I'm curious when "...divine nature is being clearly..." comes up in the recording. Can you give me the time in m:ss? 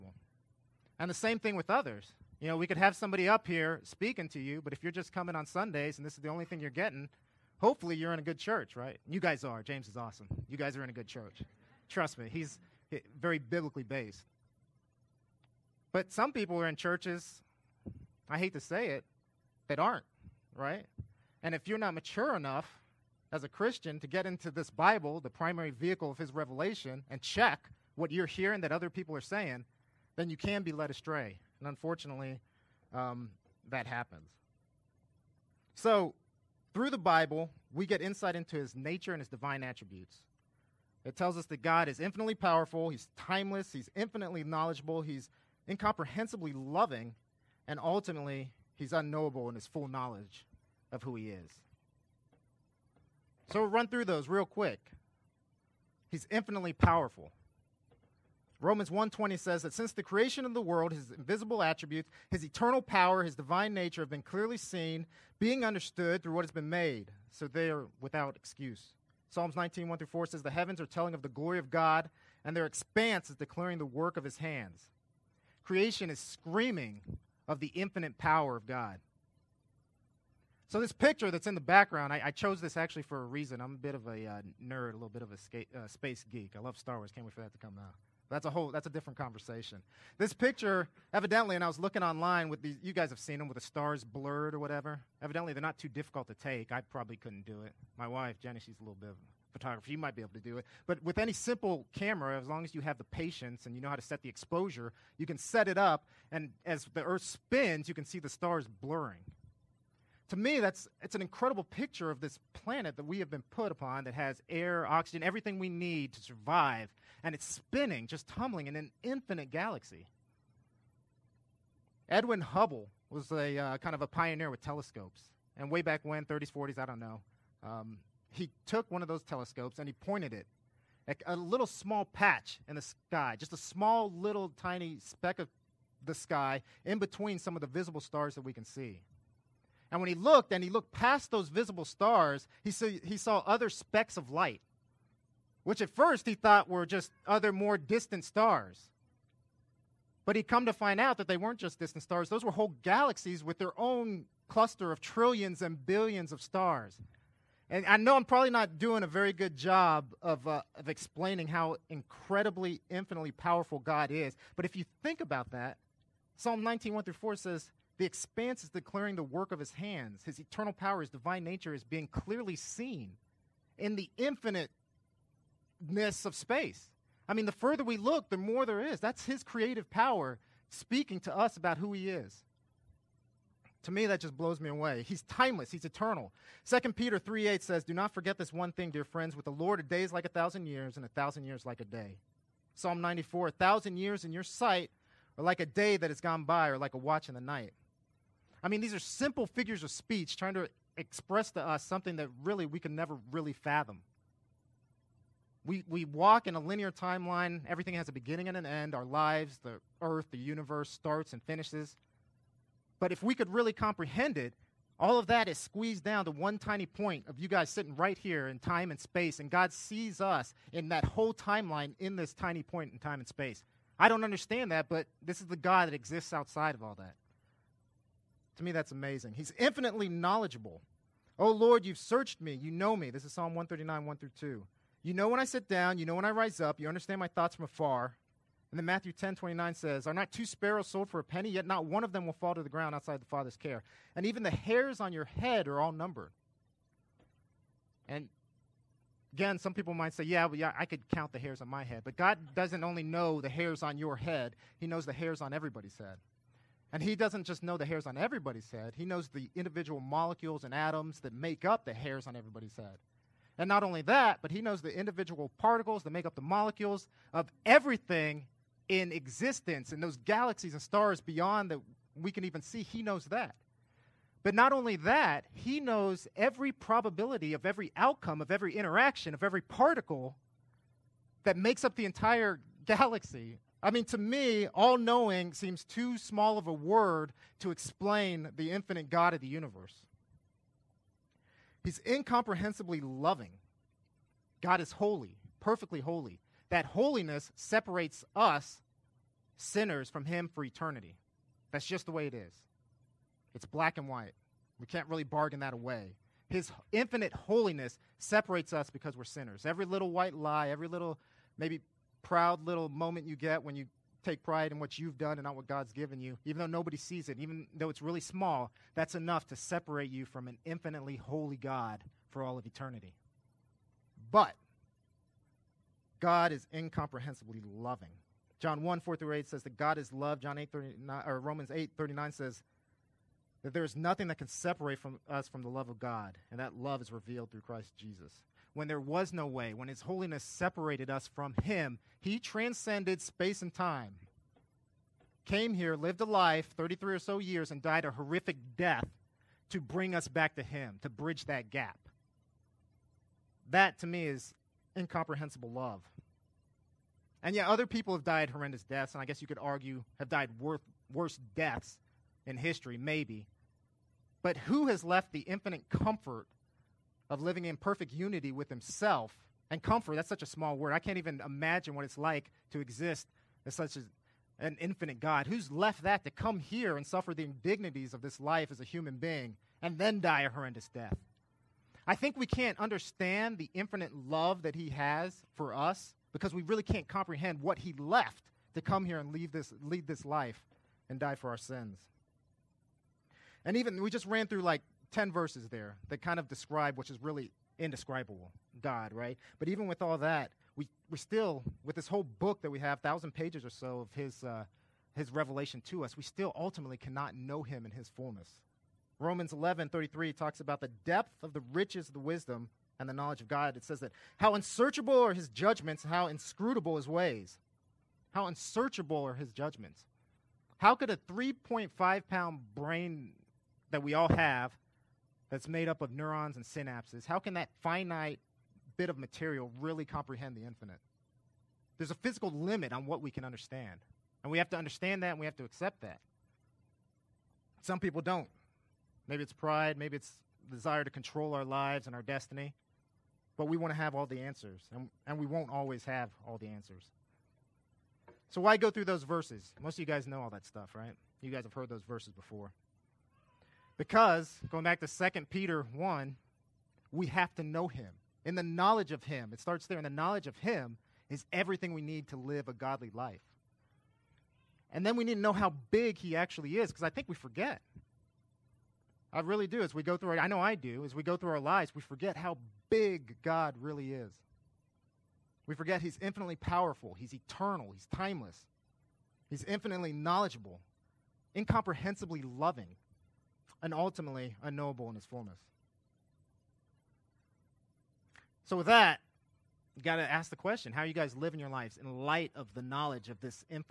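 2:51.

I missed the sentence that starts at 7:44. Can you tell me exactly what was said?
And then we need to know how big he actually is, because I think we forget.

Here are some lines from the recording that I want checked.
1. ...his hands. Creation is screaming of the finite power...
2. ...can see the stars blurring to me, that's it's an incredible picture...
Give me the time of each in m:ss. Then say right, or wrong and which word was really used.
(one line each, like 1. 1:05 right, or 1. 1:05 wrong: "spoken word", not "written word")
1. 1:14 wrong: "infinite", not "finite"
2. 1:47 right.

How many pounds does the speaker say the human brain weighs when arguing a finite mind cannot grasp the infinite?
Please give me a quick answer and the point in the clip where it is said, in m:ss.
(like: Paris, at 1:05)
3.5, at 7:01.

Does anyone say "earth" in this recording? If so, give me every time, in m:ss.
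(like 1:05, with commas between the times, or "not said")
1:47, 3:30.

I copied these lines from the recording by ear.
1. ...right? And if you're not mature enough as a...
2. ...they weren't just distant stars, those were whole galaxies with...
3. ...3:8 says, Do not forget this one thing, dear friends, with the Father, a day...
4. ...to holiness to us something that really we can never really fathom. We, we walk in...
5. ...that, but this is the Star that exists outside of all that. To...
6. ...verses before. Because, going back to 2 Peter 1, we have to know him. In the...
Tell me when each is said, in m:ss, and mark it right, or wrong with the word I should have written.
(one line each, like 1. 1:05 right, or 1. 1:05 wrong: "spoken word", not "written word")
1. 0:20 right
2. 2:31 right
3. 3:07 wrong: "Lord", not "Father"
4. 3:20 wrong: "express", not "holiness"
5. 3:44 wrong: "God", not "Star"
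6. 7:32 right.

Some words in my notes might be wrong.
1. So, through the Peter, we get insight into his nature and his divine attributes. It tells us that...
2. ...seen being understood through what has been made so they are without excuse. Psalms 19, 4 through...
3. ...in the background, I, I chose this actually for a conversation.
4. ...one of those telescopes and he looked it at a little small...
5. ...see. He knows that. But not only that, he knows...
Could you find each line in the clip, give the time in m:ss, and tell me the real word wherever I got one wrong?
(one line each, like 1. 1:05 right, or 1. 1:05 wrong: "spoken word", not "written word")
1. 0:35 wrong: "Bible", not "Peter"
2. 1:04 wrong: "1", not "4"
3. 1:21 wrong: "reason", not "conversation"
4. 2:08 wrong: "pointed", not "looked"
5. 4:32 right.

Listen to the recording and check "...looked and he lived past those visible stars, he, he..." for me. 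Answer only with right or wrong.
wrong.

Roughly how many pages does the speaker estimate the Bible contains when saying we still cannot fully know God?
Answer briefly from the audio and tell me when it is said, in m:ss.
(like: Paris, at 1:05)
1000, at 6:42.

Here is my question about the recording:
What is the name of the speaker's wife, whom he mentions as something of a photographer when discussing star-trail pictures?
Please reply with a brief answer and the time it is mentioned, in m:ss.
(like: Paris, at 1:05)
Jenny, at 1:38.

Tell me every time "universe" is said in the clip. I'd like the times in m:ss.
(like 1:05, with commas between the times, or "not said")
3:30, 4:49.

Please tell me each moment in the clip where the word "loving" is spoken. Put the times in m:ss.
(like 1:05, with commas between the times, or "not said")
0:46, 4:52, 5:27, 8:02.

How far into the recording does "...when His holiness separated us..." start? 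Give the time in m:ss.
5:39.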